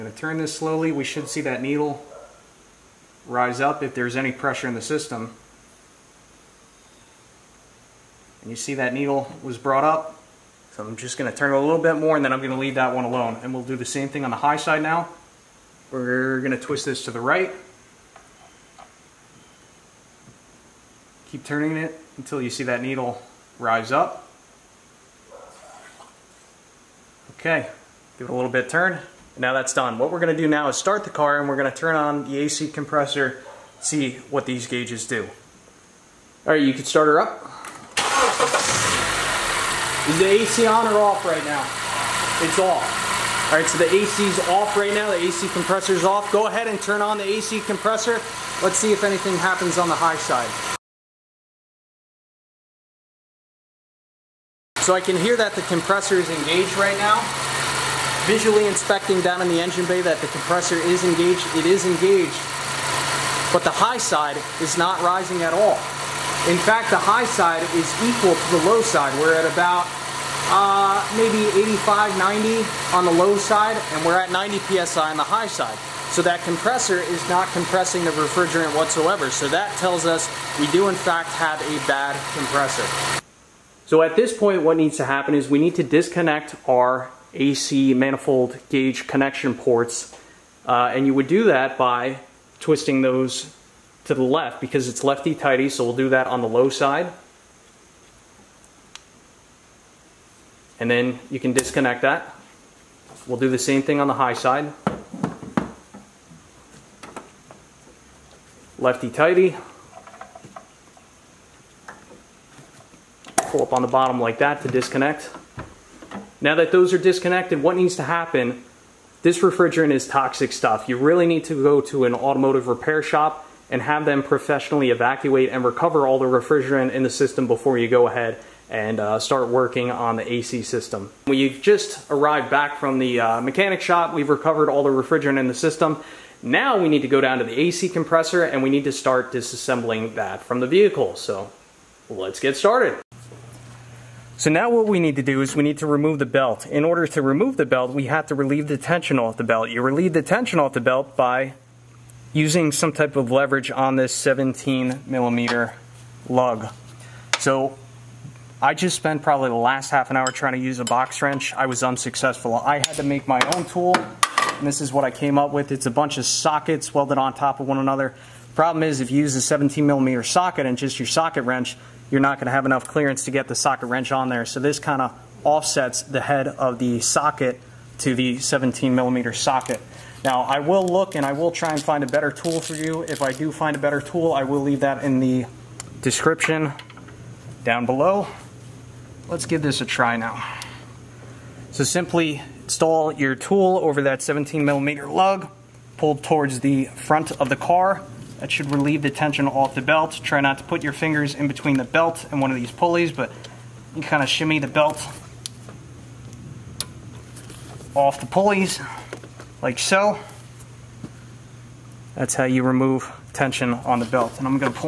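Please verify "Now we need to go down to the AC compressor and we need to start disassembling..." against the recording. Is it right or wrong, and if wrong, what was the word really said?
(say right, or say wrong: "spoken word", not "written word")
right.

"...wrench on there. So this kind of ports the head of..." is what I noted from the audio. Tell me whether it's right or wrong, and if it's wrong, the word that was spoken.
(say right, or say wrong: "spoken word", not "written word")
wrong: "offsets", not "ports".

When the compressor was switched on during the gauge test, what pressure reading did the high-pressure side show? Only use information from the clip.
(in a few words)
90 PSI.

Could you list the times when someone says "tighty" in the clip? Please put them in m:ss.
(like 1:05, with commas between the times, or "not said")
1:35, 1:48.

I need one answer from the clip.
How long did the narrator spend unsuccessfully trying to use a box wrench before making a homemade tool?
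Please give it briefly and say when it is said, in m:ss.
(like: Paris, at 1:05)
Half an hour, at 2:39.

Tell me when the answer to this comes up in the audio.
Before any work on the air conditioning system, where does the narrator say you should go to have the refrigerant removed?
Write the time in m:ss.
2:02.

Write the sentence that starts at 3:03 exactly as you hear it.
If I do find a better tool, I will leave that in the description down below.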